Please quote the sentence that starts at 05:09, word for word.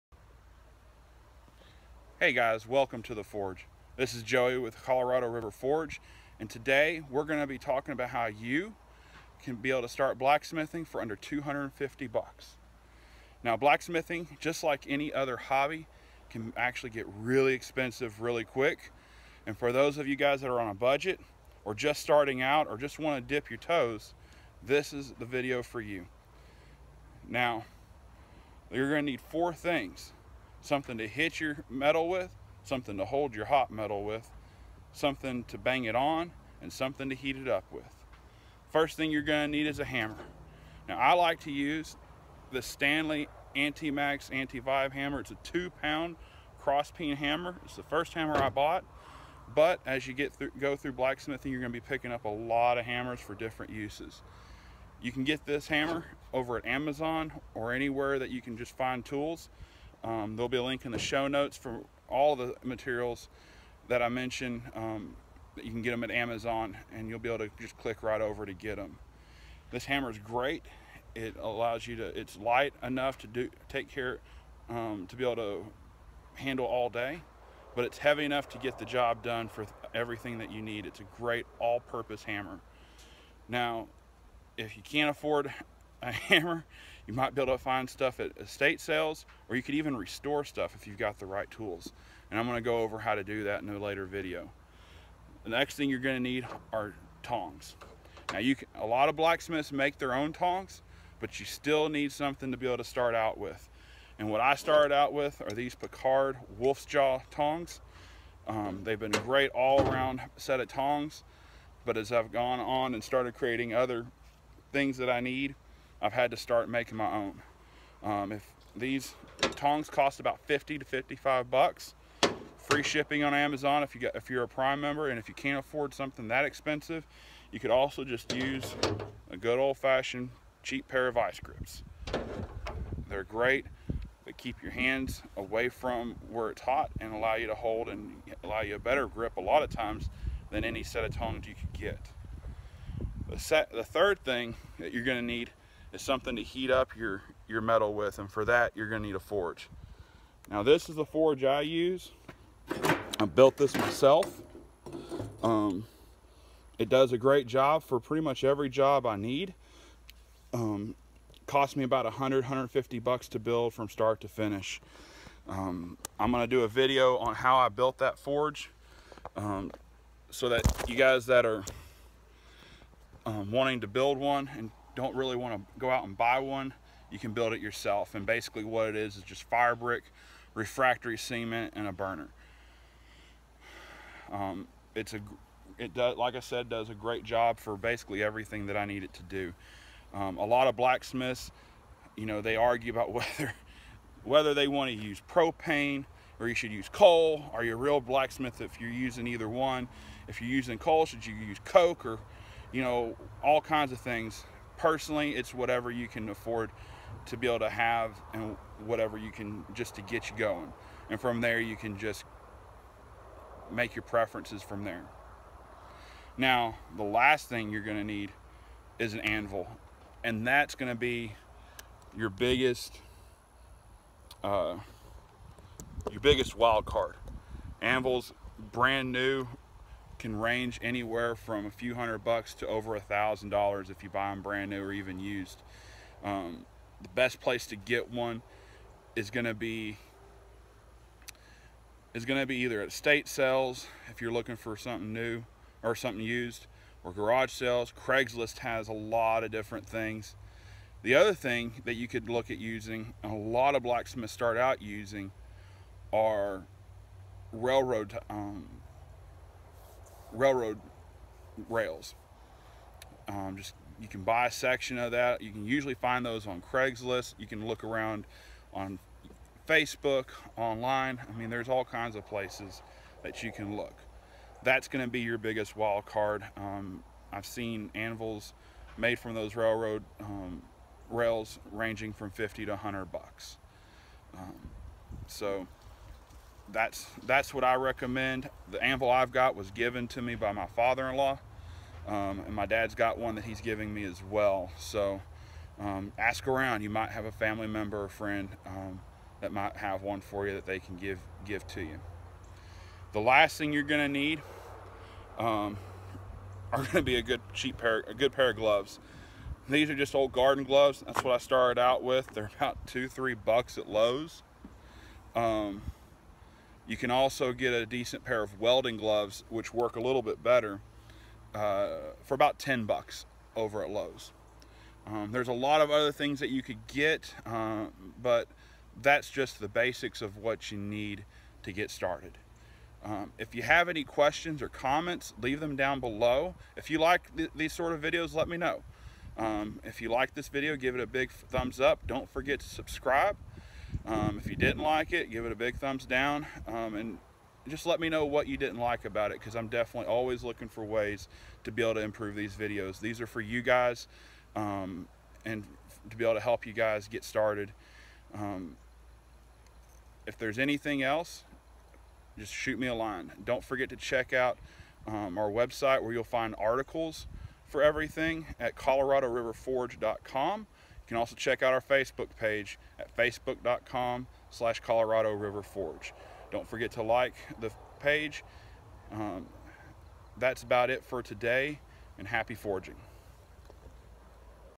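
These are just old garden gloves.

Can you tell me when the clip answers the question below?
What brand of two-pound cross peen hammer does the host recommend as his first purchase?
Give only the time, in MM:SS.
00:42.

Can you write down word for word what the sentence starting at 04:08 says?
Craigslist has a lot of different things.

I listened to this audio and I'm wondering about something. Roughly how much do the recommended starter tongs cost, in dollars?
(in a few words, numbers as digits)
50 to 55.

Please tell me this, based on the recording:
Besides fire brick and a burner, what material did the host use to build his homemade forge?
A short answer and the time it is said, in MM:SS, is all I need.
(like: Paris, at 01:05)
refractory cement, at 03:00.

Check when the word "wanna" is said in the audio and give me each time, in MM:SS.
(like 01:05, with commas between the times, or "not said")
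00:22.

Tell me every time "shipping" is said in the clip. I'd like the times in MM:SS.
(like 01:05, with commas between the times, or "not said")
02:02.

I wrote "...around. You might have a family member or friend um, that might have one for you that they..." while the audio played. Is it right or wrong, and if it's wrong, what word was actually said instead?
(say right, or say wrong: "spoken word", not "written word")
right.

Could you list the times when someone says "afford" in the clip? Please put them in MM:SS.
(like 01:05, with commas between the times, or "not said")
01:25, 02:05, 03:26.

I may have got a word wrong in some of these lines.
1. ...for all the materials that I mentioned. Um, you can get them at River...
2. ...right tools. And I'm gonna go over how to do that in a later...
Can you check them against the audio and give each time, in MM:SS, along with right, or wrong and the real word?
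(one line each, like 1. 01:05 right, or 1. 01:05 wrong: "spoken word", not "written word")
1. 01:01 wrong: "Amazon", not "River"
2. 01:31 right.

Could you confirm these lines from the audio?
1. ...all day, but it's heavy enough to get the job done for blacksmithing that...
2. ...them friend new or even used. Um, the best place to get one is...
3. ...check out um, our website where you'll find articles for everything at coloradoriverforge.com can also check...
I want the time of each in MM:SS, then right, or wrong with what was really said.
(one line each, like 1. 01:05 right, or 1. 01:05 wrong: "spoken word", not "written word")
1. 01:16 wrong: "everything", not "blacksmithing"
2. 03:54 wrong: "brand", not "friend"
3. 06:03 right.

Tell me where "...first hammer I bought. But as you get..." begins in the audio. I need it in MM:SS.
00:47.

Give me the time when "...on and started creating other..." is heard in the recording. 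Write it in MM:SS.
01:52.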